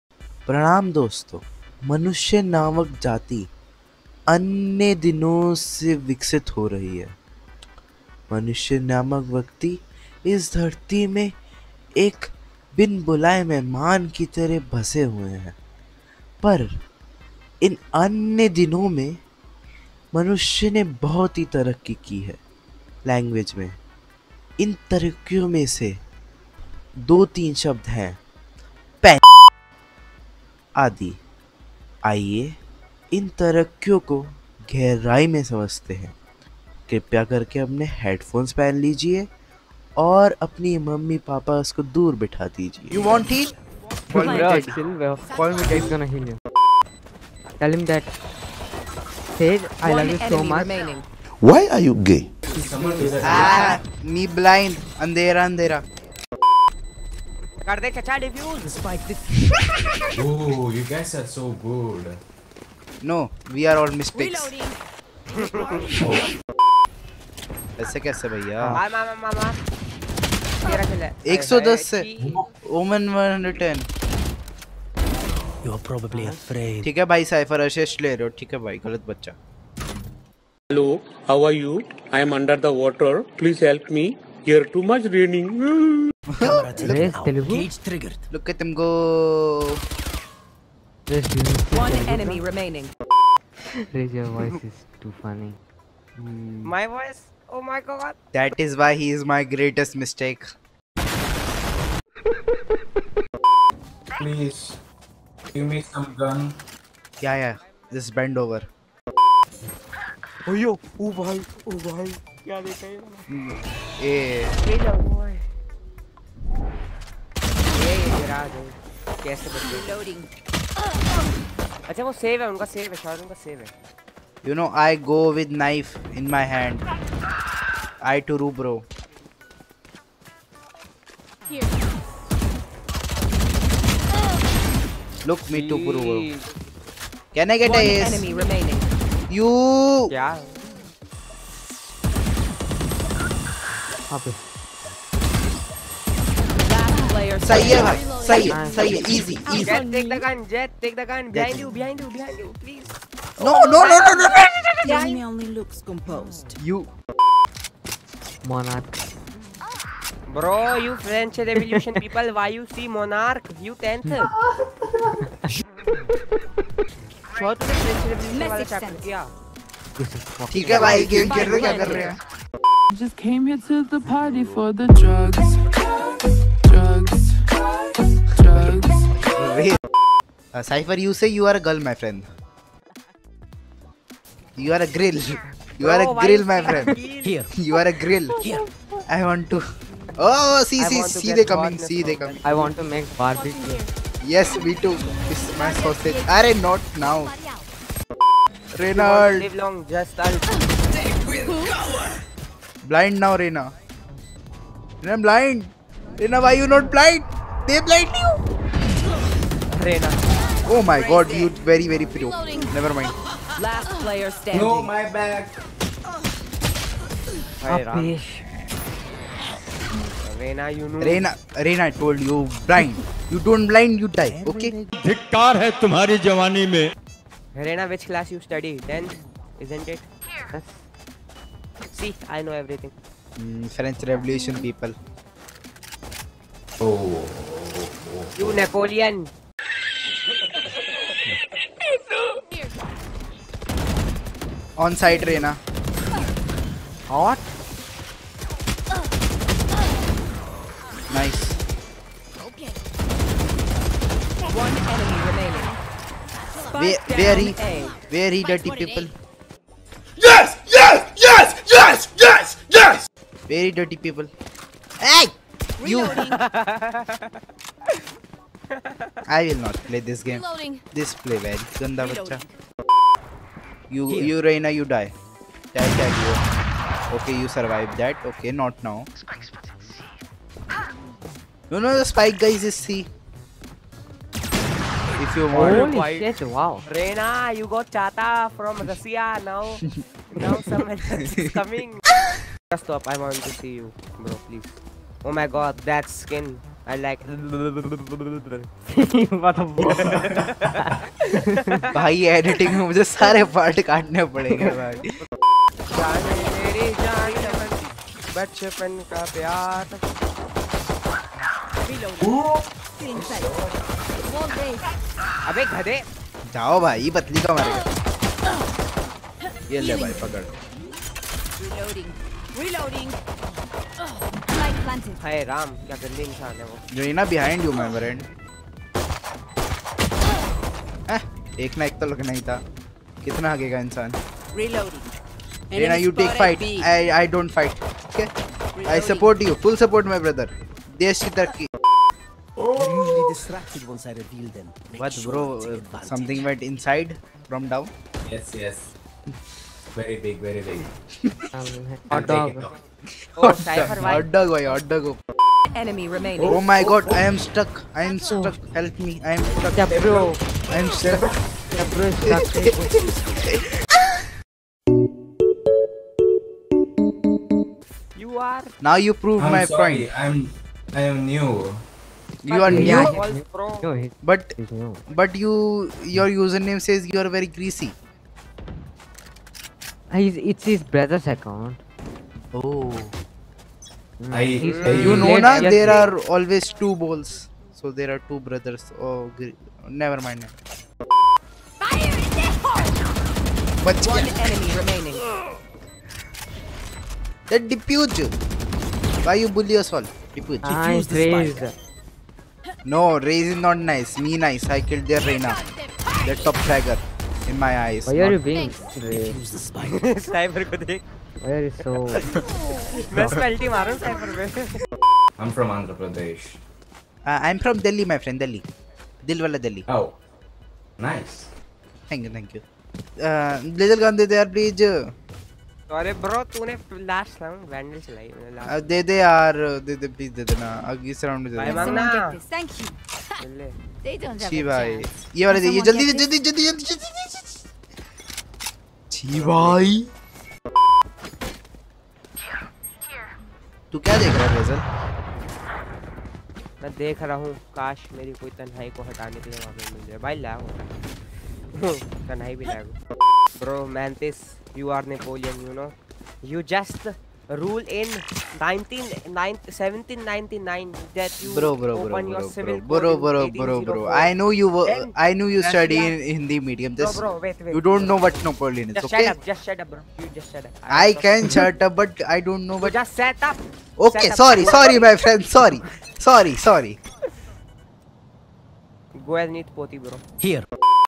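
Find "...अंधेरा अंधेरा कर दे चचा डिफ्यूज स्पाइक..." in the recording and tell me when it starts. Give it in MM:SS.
00:55.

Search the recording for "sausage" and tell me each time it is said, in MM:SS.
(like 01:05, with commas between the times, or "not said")
03:15.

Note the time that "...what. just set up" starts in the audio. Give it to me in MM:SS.
07:52.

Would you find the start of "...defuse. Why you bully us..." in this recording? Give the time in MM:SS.
06:37.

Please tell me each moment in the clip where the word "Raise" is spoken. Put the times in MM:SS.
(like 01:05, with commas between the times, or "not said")
01:33.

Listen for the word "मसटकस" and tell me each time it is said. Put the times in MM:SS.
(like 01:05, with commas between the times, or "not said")
01:04.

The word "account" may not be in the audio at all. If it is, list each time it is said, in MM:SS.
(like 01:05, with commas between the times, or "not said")
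06:21.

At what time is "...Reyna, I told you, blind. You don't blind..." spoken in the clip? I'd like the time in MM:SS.
03:41.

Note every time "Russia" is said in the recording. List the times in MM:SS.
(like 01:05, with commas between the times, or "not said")
04:48.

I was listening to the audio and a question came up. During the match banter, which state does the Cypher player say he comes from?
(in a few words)
Andhra Pradesh.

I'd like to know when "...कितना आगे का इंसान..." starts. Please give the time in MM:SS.
05:33.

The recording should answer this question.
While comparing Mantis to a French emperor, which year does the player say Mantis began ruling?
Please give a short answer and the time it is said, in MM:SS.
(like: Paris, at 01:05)
1799, at 07:39.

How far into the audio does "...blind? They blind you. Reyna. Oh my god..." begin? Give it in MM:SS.
03:26.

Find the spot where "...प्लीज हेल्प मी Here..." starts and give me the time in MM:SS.
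01:23.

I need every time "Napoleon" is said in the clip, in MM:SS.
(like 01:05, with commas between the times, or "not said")
03:58, 07:35, 07:48.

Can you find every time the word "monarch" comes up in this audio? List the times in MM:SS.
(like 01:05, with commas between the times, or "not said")
02:38, 02:42.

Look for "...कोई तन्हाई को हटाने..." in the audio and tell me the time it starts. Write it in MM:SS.
07:28.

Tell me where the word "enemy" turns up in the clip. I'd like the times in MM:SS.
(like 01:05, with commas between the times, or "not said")
01:32, 02:18, 02:34, 04:14, 05:55, 06:34.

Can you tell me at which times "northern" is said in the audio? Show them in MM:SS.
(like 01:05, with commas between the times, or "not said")
not said.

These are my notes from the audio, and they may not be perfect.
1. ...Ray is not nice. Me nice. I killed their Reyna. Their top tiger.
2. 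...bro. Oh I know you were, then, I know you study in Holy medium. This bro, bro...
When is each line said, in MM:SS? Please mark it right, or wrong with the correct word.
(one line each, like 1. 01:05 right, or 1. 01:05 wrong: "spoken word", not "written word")
1. 06:43 right
2. 07:43 wrong: "Hindi", not "Holy".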